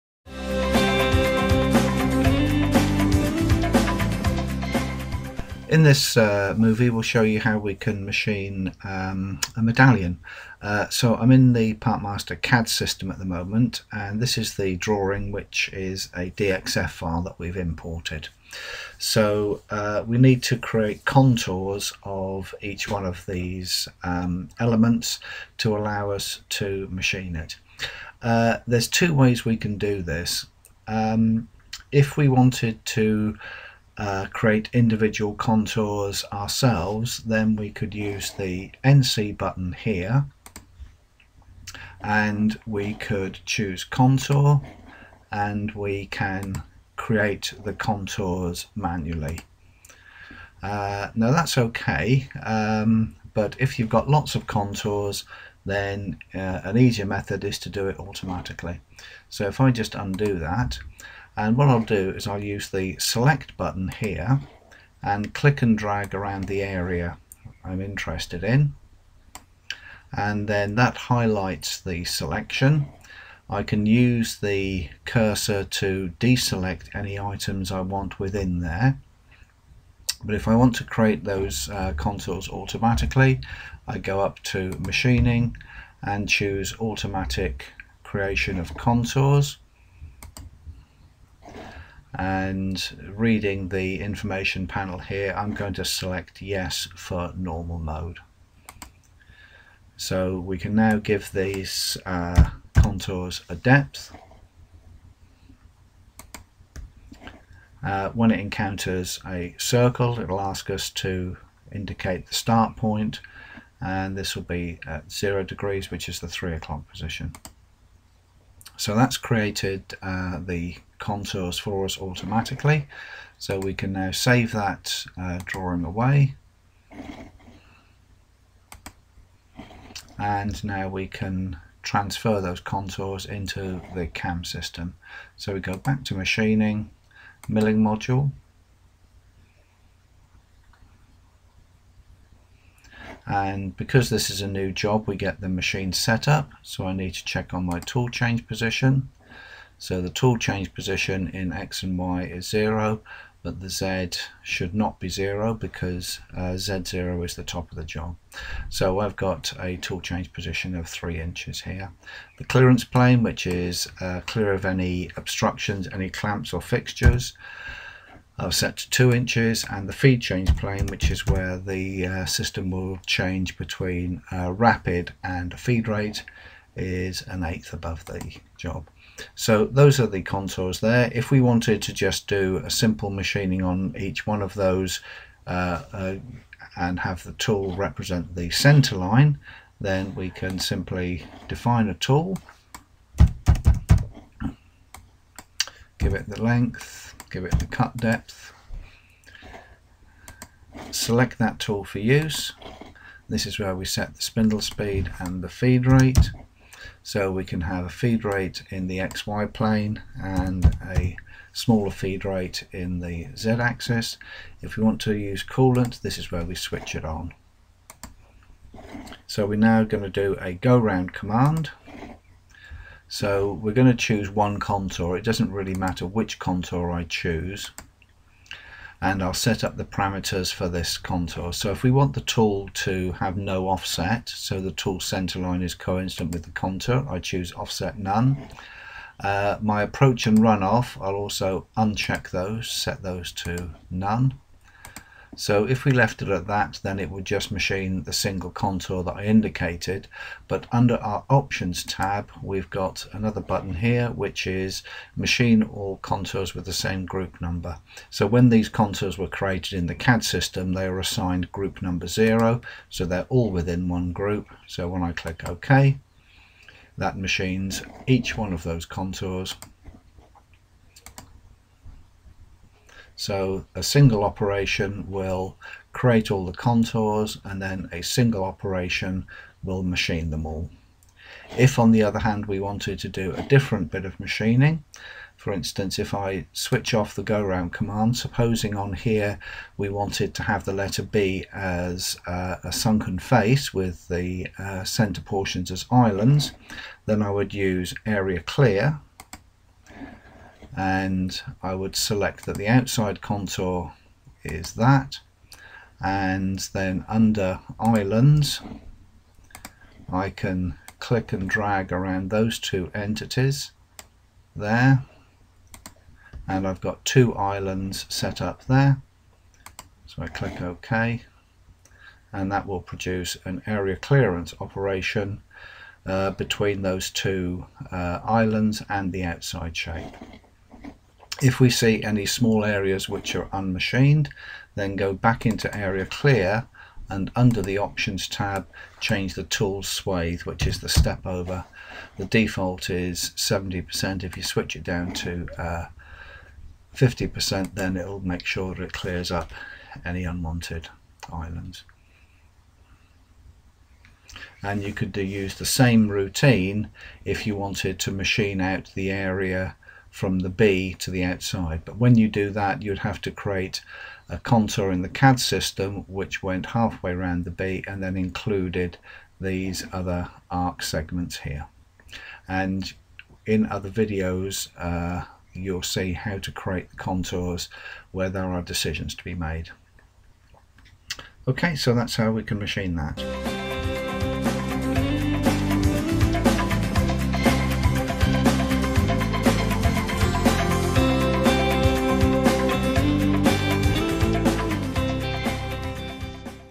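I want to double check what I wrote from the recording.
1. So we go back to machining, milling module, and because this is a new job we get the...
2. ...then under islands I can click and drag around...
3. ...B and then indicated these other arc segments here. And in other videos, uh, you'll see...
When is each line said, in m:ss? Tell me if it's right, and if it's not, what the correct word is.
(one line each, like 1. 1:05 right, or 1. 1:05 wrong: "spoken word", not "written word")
1. 2:15 right
2. 5:06 right
3. 6:07 wrong: "included", not "indicated".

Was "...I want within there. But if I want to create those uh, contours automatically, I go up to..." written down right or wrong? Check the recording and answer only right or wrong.
right.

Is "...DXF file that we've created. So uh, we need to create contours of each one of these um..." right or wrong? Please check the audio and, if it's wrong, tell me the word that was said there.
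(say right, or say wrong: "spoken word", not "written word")
wrong: "imported", not "created".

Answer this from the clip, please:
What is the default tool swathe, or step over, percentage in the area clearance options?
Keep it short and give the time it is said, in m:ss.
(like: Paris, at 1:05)
70%, at 5:43.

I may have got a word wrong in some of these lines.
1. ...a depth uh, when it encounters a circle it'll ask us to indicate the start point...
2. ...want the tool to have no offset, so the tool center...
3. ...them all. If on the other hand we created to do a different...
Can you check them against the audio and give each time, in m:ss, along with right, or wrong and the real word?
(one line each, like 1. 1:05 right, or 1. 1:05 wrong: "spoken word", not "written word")
1. 1:43 right
2. 3:51 right
3. 4:40 wrong: "wanted", not "created".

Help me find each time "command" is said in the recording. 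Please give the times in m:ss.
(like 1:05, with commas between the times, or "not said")
3:41, 4:47.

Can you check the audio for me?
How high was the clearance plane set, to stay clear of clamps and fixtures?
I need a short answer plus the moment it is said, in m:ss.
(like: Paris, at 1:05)
2 inches, at 2:48.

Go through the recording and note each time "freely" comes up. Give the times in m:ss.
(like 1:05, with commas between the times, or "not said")
not said.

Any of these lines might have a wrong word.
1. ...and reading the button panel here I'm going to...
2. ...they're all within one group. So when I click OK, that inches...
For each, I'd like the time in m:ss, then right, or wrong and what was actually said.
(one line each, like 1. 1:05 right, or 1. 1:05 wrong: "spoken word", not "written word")
1. 1:32 wrong: "information", not "button"
2. 4:23 wrong: "machines", not "inches".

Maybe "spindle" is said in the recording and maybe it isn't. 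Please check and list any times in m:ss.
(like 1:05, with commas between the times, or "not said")
3:24.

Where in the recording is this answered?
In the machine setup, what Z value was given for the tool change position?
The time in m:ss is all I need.
2:40.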